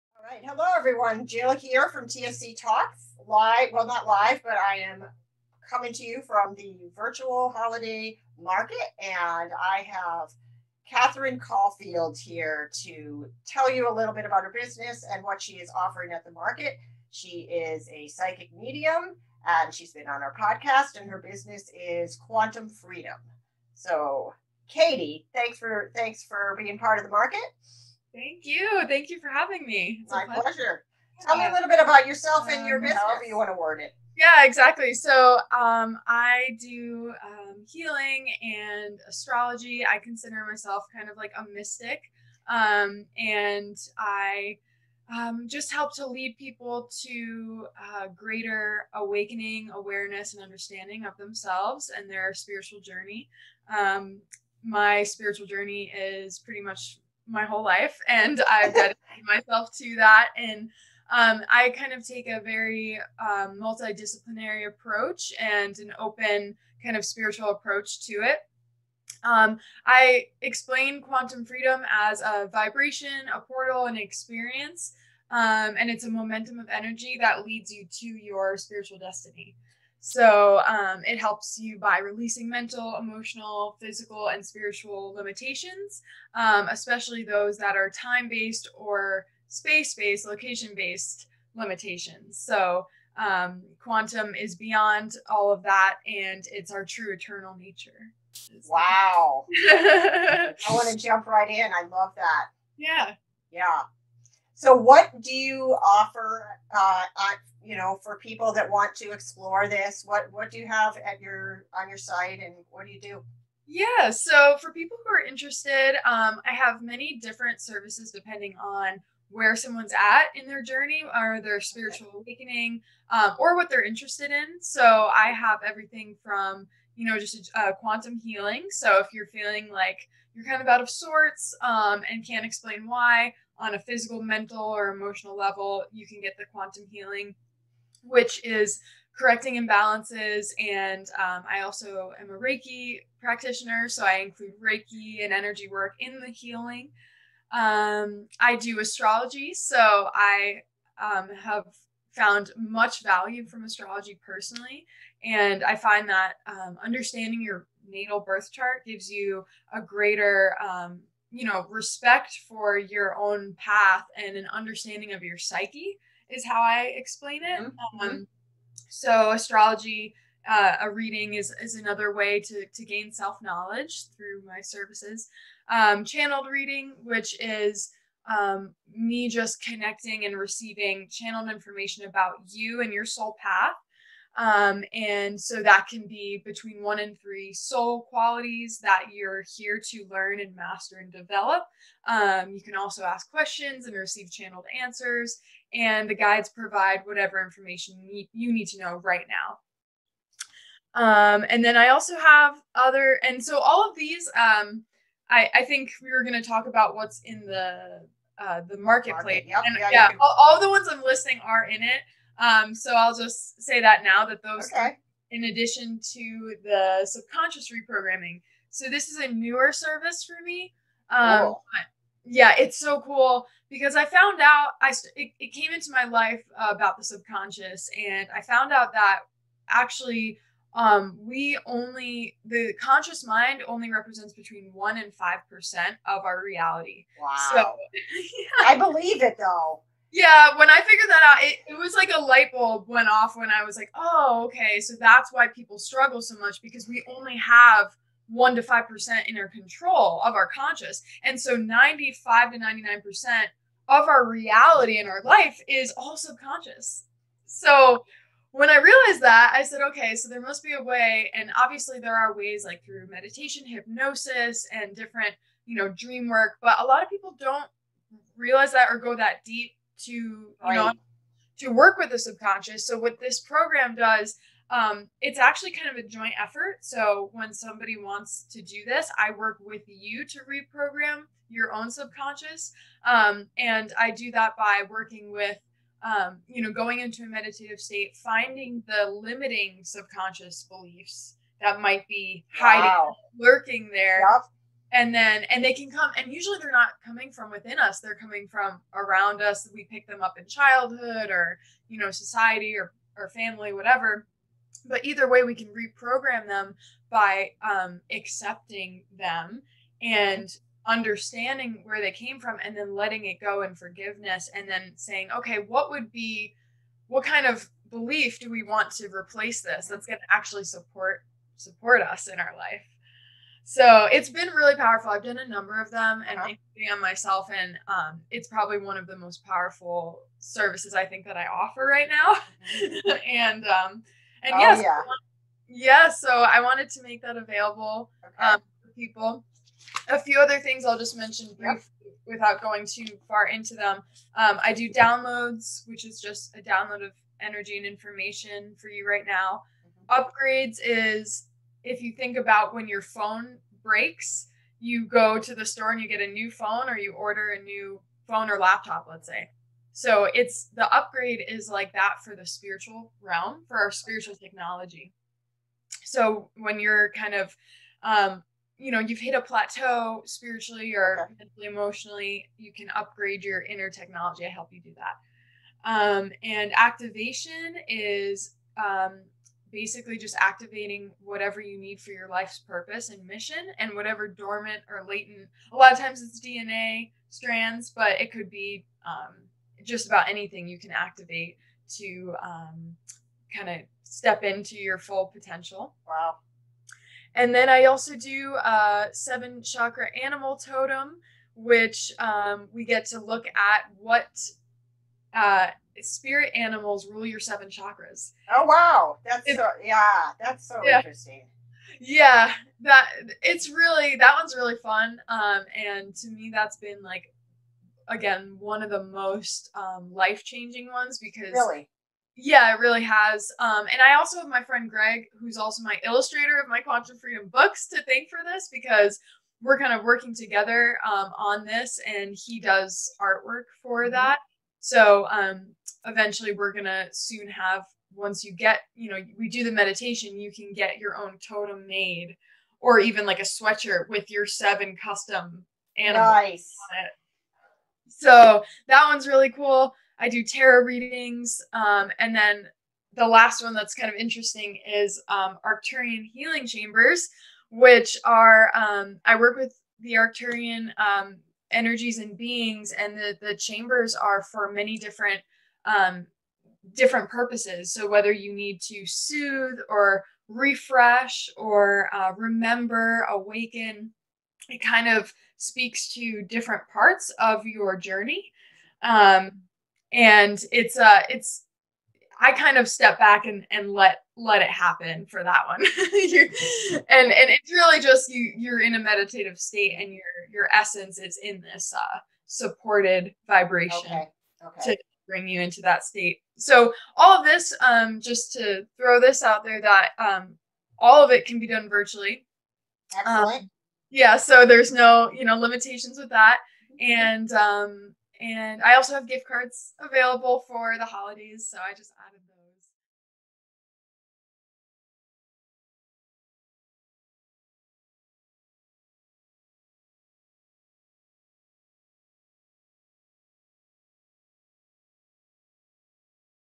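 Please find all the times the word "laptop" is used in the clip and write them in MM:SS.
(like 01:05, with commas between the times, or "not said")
05:58.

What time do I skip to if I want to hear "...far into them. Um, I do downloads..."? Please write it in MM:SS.
05:43.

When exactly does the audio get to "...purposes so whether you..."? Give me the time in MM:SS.
07:47.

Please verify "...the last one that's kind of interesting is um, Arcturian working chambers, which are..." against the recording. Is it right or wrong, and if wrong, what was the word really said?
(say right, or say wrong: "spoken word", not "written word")
wrong: "healing", not "working".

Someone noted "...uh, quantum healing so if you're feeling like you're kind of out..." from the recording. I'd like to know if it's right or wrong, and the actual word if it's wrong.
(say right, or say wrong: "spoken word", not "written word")
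right.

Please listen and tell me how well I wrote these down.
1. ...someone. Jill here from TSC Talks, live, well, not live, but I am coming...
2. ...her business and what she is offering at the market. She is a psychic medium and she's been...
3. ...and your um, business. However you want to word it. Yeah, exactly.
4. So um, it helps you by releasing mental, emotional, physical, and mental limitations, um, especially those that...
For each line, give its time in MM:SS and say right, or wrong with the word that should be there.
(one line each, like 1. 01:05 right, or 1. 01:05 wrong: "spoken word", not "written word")
1. 00:00 wrong: "everyone", not "someone"
2. 00:14 right
3. 00:32 right
4. 01:20 wrong: "spiritual", not "mental".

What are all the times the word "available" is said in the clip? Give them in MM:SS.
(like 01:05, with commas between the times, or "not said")
05:37, 08:30.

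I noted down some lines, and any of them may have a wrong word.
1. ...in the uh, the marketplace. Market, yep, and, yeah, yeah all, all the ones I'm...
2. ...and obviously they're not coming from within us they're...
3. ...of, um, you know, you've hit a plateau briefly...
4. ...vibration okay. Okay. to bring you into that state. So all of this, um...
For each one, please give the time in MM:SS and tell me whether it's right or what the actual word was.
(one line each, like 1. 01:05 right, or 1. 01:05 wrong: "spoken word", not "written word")
1. 03:27 right
2. 04:56 wrong: "usually", not "obviously"
3. 06:07 wrong: "spiritually", not "briefly"
4. 08:13 right.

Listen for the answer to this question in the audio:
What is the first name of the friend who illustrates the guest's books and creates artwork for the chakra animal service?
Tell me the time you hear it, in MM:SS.
07:04.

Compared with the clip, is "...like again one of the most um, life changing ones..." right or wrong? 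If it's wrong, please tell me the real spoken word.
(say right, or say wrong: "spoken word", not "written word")
right.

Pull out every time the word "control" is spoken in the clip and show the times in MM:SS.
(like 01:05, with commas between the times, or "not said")
04:09.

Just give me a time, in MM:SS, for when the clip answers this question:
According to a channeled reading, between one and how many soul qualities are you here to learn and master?
03:07.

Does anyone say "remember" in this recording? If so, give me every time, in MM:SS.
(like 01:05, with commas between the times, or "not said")
07:52.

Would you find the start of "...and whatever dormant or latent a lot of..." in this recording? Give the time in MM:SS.
06:23.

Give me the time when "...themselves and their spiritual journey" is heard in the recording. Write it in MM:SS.
00:51.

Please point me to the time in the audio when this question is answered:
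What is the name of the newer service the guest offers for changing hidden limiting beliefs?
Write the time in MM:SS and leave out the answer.
03:37.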